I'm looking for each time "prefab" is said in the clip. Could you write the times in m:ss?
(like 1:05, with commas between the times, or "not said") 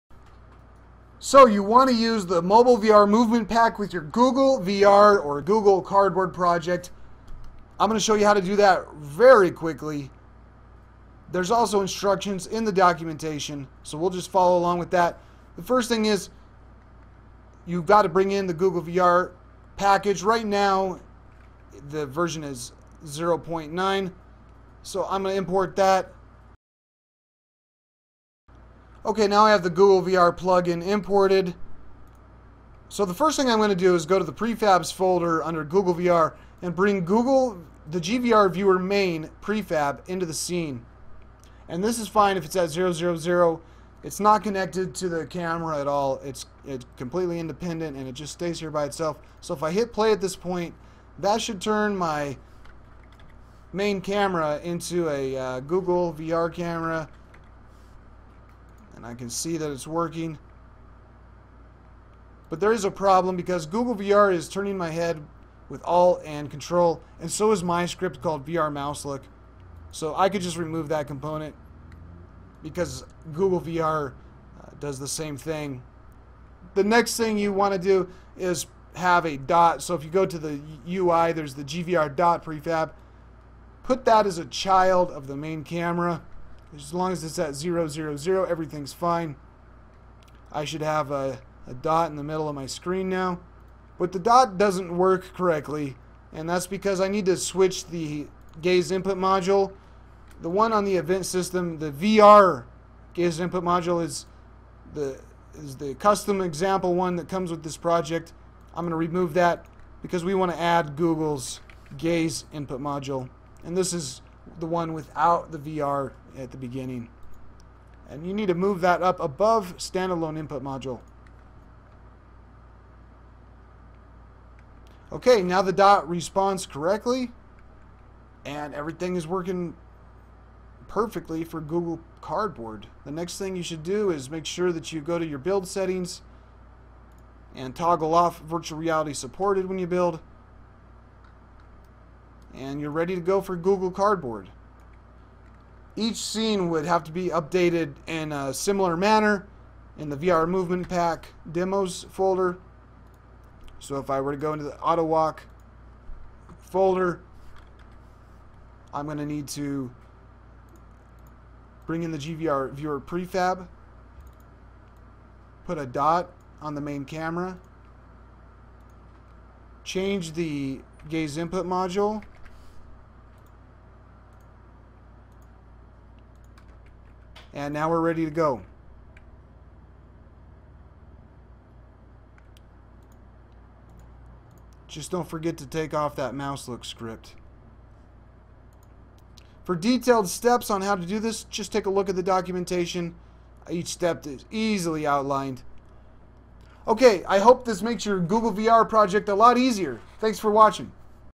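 0:34, 0:39, 1:22, 2:43.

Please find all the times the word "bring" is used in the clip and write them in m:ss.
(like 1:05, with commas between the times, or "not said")
0:18, 0:36, 2:41.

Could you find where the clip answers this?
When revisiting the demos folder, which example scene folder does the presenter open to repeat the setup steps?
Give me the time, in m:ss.
2:34.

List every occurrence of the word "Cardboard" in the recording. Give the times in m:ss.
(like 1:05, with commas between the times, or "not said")
0:05, 2:12, 2:23.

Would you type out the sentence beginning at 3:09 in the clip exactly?
For detailed steps on how to do this, just take a look at the documentation.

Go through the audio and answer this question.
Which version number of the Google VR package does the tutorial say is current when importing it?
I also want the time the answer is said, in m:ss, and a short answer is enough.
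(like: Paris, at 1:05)
0.9, at 0:23.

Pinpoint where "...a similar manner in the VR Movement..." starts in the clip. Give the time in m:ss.
2:28.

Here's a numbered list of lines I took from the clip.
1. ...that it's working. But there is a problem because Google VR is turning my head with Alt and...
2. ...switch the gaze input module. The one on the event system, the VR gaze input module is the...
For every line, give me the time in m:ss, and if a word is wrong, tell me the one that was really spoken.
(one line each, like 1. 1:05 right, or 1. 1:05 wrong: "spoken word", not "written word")
1. 0:59 right
2. 1:37 right.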